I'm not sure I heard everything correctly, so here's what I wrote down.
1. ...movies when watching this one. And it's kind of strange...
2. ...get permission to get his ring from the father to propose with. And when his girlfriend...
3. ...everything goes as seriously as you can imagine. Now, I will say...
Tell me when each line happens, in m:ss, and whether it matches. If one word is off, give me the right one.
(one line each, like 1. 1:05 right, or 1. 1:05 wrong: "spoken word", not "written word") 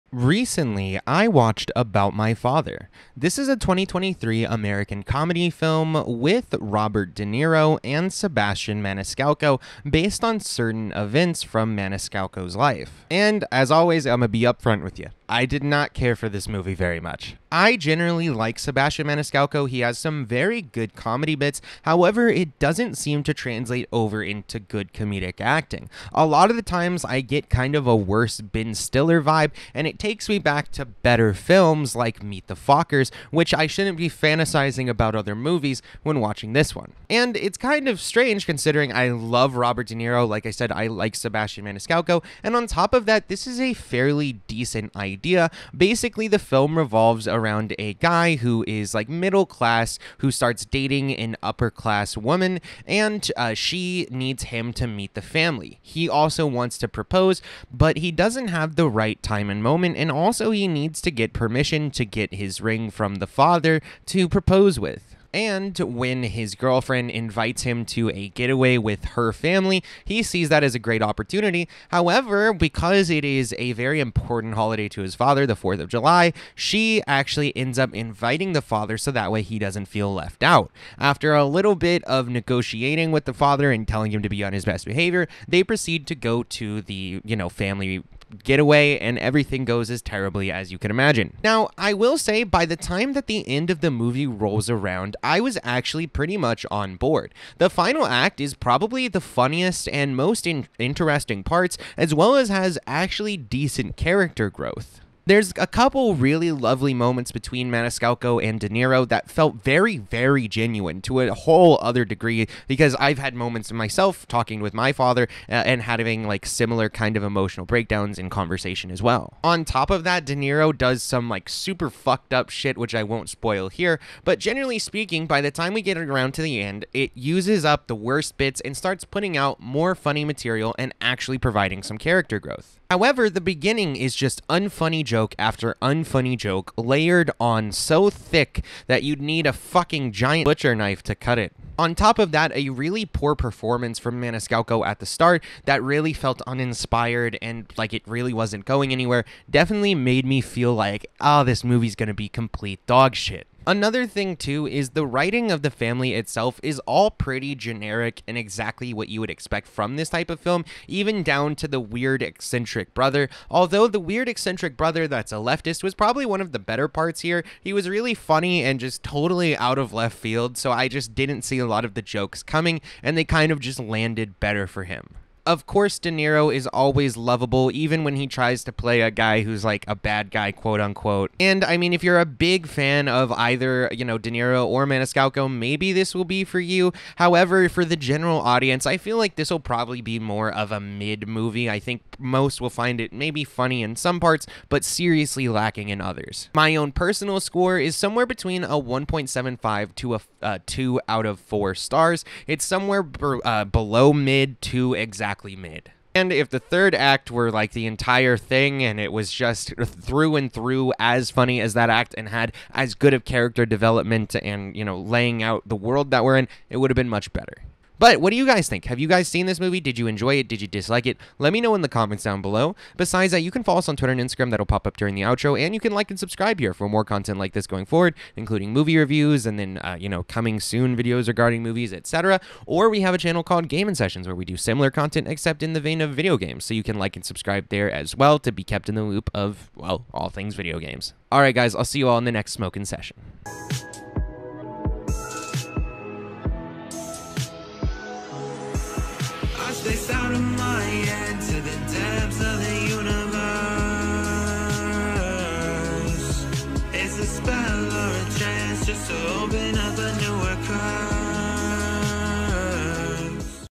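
1. 0:35 right
2. 1:01 right
3. 1:29 wrong: "terribly", not "seriously".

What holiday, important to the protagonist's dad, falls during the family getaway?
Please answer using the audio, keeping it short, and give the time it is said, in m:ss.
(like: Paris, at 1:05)
4th of July, at 1:15.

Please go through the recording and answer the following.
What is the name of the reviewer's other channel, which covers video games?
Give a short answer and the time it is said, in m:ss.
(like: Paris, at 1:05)
Gaming Sessions, at 3:53.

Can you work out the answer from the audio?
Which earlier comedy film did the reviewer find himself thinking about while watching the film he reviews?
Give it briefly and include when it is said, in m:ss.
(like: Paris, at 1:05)
Meet the Fockers, at 0:32.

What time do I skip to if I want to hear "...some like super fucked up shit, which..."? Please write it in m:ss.
2:01.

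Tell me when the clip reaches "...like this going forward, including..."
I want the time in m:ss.
3:47.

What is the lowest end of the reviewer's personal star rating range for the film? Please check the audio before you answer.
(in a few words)
1.75.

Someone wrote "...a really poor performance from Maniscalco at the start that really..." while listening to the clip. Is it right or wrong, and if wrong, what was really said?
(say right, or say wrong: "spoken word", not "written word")
right.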